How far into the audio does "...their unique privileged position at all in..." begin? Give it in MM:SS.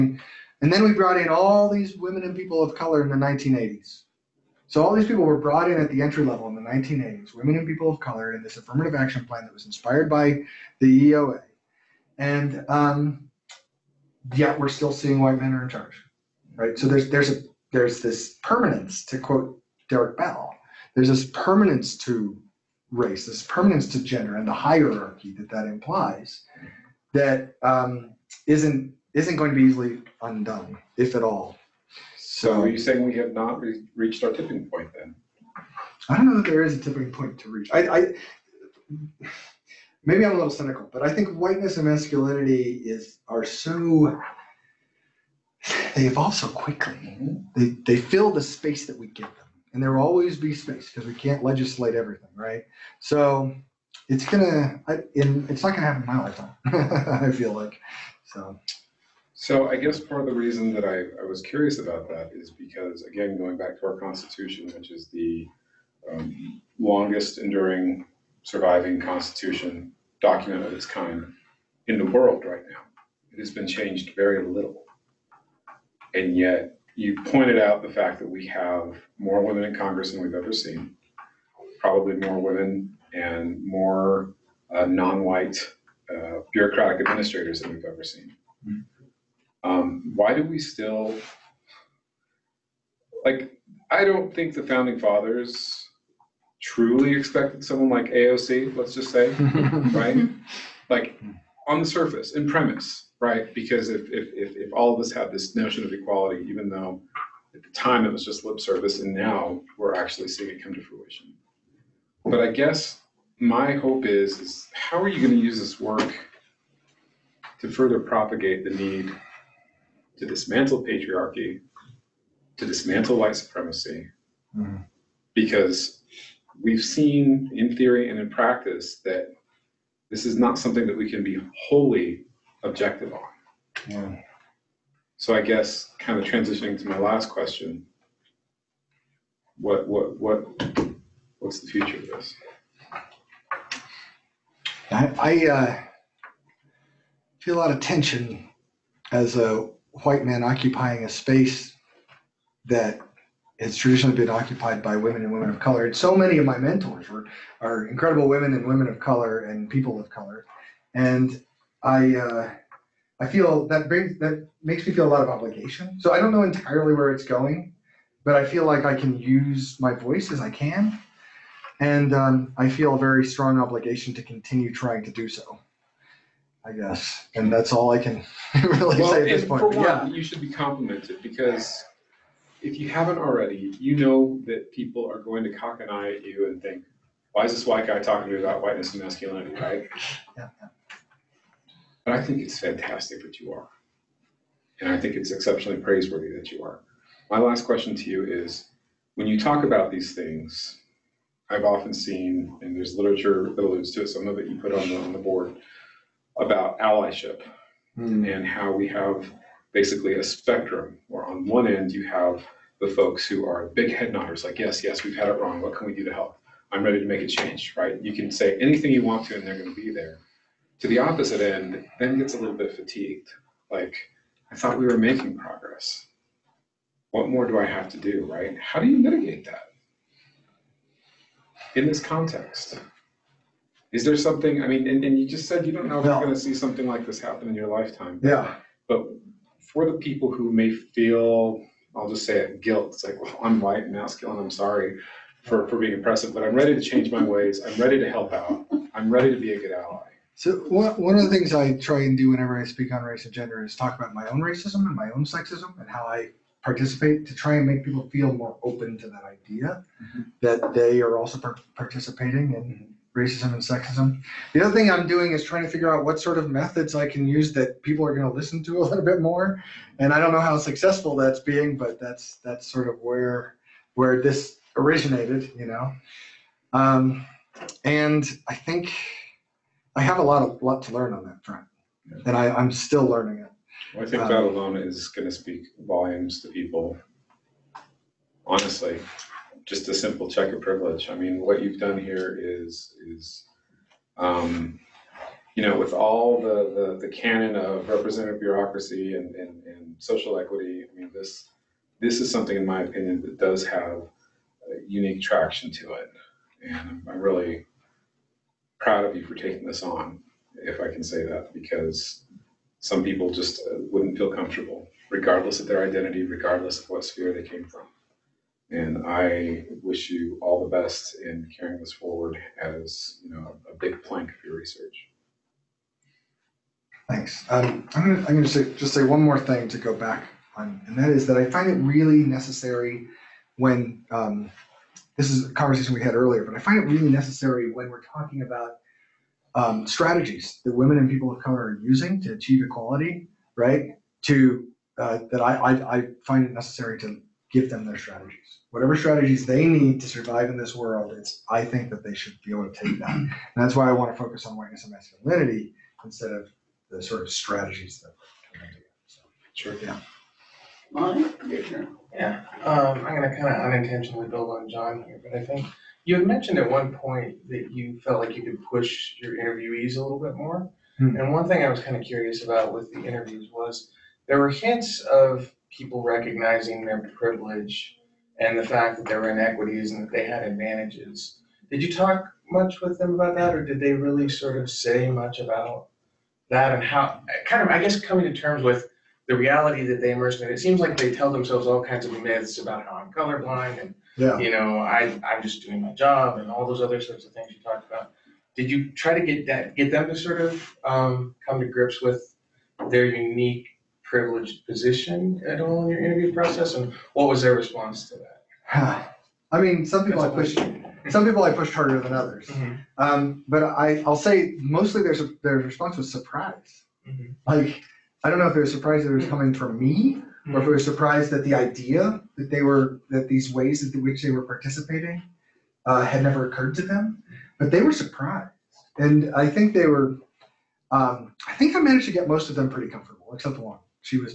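06:42.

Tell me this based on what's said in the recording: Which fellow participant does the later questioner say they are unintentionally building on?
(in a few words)
John.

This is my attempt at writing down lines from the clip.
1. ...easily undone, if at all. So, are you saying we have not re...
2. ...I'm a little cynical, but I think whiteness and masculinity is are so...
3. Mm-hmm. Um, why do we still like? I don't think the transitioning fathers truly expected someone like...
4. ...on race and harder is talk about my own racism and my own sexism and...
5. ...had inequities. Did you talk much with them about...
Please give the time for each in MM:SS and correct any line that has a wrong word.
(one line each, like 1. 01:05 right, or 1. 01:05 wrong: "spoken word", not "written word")
1. 00:29 right
2. 00:40 right
3. 01:28 wrong: "founding", not "transitioning"
4. 04:12 wrong: "gender", not "harder"
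5. 06:20 wrong: "advantages", not "inequities".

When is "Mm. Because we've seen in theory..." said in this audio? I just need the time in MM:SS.
02:04.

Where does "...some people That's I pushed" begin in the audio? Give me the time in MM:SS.
06:49.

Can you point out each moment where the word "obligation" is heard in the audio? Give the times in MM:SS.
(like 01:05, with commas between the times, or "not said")
02:45, 02:53.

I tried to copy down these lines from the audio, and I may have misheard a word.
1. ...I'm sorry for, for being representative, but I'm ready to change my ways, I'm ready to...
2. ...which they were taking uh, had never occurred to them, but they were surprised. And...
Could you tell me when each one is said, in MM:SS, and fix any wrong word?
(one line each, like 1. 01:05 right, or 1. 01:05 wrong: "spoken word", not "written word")
1. 04:04 wrong: "oppressive", not "representative"
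2. 07:04 wrong: "participating", not "taking".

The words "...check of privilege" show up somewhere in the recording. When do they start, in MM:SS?
04:50.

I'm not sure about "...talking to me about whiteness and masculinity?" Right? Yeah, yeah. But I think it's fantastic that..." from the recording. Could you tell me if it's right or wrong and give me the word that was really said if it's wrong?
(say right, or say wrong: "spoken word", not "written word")
right.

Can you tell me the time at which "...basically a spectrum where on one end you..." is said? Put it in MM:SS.
03:29.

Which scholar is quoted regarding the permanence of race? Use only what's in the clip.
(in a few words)
Derek Bell.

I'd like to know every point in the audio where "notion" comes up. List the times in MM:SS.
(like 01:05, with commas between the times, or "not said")
01:45.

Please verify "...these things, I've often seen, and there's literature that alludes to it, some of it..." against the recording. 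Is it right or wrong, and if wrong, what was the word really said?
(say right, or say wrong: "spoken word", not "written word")
right.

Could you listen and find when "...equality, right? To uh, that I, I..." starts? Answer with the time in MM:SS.
05:42.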